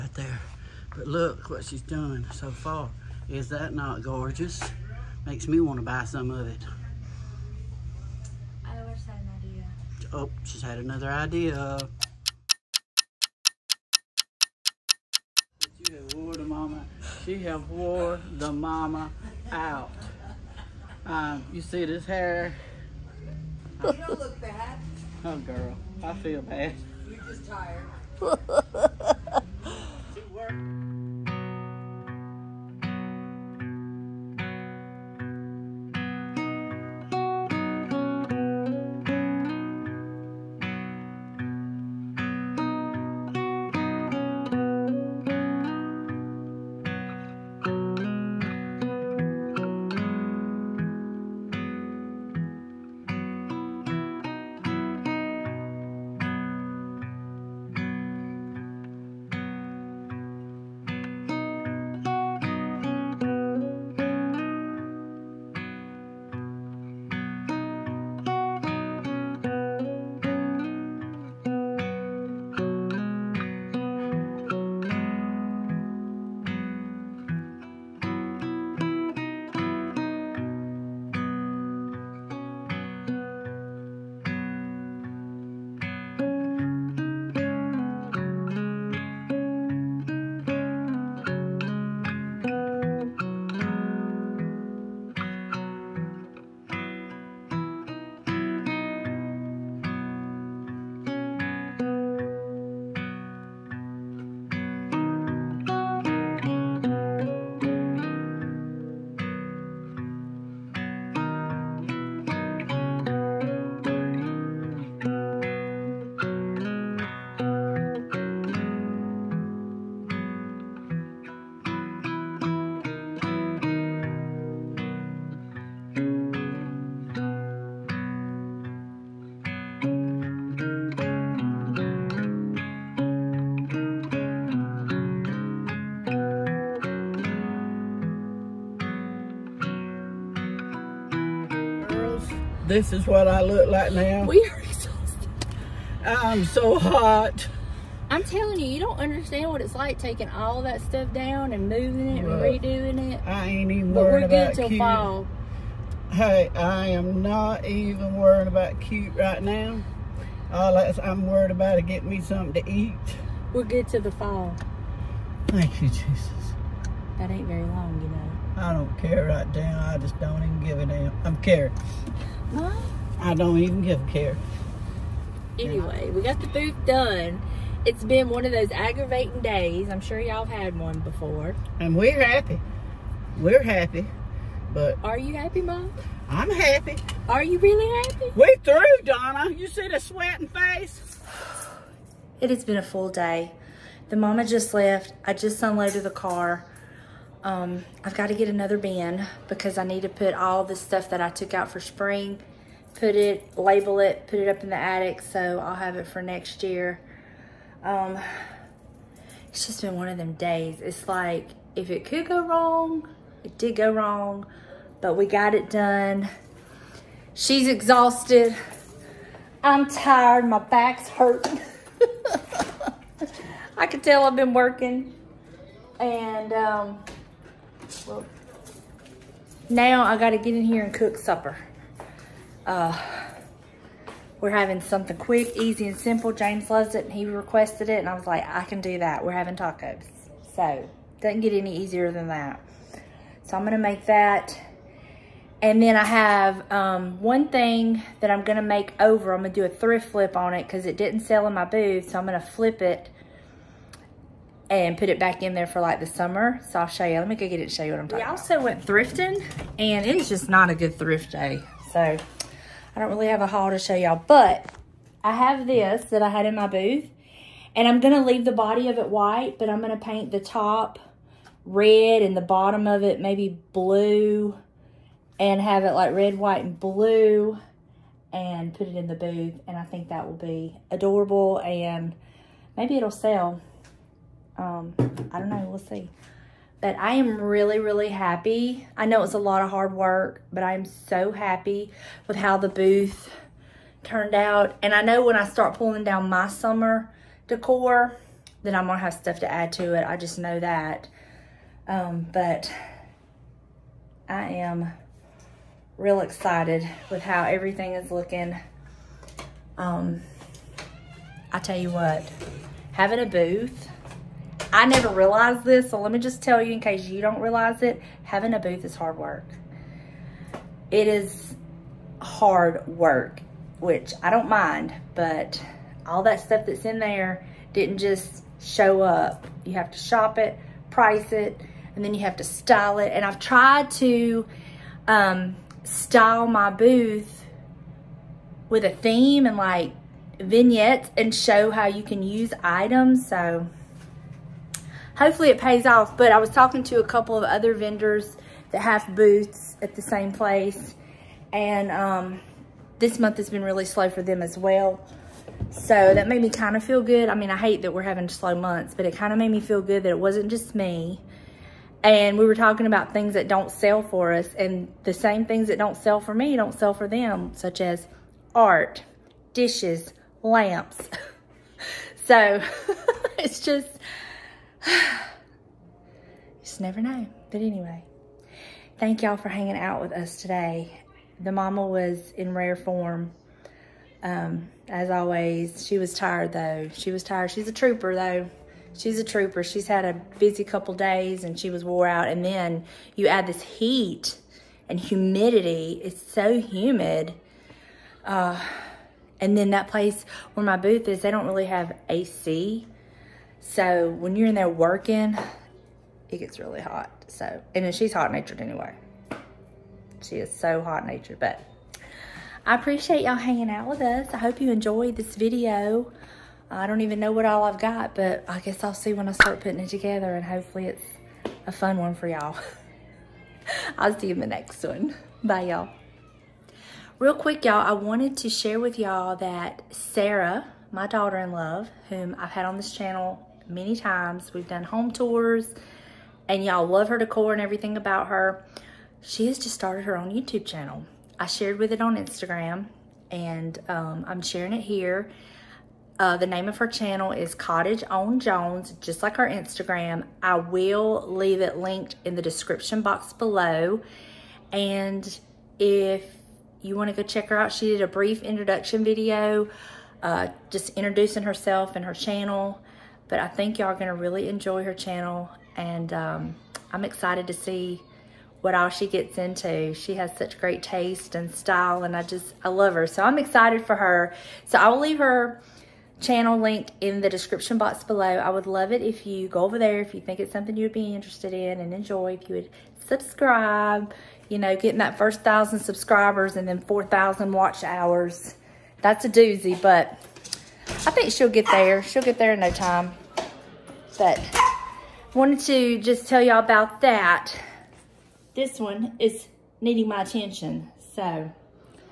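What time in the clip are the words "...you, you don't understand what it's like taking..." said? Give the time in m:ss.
2:28.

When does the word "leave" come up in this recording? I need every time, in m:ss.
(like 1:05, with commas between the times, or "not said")
4:28, 7:31, 7:54.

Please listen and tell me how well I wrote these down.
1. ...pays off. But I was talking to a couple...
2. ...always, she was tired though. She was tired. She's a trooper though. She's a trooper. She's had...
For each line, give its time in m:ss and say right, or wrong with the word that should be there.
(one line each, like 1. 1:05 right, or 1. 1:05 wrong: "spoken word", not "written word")
1. 5:45 right
2. 6:25 right.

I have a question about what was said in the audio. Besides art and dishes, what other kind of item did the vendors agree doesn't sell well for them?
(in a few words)
Lamps.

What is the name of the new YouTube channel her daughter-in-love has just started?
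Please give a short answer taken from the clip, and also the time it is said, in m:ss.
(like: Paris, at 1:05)
Cottage on Jones, at 7:27.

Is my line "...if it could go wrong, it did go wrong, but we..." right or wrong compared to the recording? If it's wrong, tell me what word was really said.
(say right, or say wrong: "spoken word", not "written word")
right.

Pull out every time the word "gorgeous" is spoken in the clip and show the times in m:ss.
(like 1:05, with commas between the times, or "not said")
0:04.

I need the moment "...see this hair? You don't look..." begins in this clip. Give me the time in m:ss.
0:21.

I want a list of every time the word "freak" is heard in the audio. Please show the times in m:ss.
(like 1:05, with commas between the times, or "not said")
not said.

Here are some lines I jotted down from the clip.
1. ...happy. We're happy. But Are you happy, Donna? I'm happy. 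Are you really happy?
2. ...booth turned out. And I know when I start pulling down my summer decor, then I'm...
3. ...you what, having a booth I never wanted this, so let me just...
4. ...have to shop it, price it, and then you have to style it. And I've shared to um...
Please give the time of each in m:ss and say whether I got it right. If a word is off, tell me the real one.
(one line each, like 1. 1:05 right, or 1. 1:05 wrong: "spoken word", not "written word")
1. 3:02 wrong: "Mom", not "Donna"
2. 4:52 right
3. 5:11 wrong: "realized", not "wanted"
4. 5:29 wrong: "tried", not "shared".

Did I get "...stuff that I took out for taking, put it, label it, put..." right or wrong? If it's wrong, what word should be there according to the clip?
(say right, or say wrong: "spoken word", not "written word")
wrong: "spring", not "taking".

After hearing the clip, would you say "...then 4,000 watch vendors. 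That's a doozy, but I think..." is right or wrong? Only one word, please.
wrong.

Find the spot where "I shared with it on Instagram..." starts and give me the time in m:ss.
7:21.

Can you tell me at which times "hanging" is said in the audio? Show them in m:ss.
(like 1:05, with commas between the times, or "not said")
6:19, 6:53.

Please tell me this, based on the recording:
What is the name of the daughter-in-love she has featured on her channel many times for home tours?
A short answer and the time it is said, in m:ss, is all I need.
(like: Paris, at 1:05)
Sara, at 7:09.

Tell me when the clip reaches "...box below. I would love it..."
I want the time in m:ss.
7:57.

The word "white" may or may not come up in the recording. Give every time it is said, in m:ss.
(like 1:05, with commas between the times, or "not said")
4:29, 4:36.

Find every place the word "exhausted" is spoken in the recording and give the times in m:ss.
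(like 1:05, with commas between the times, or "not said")
2:24, 3:37.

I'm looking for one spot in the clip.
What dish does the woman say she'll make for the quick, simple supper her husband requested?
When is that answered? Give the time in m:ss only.
3:59.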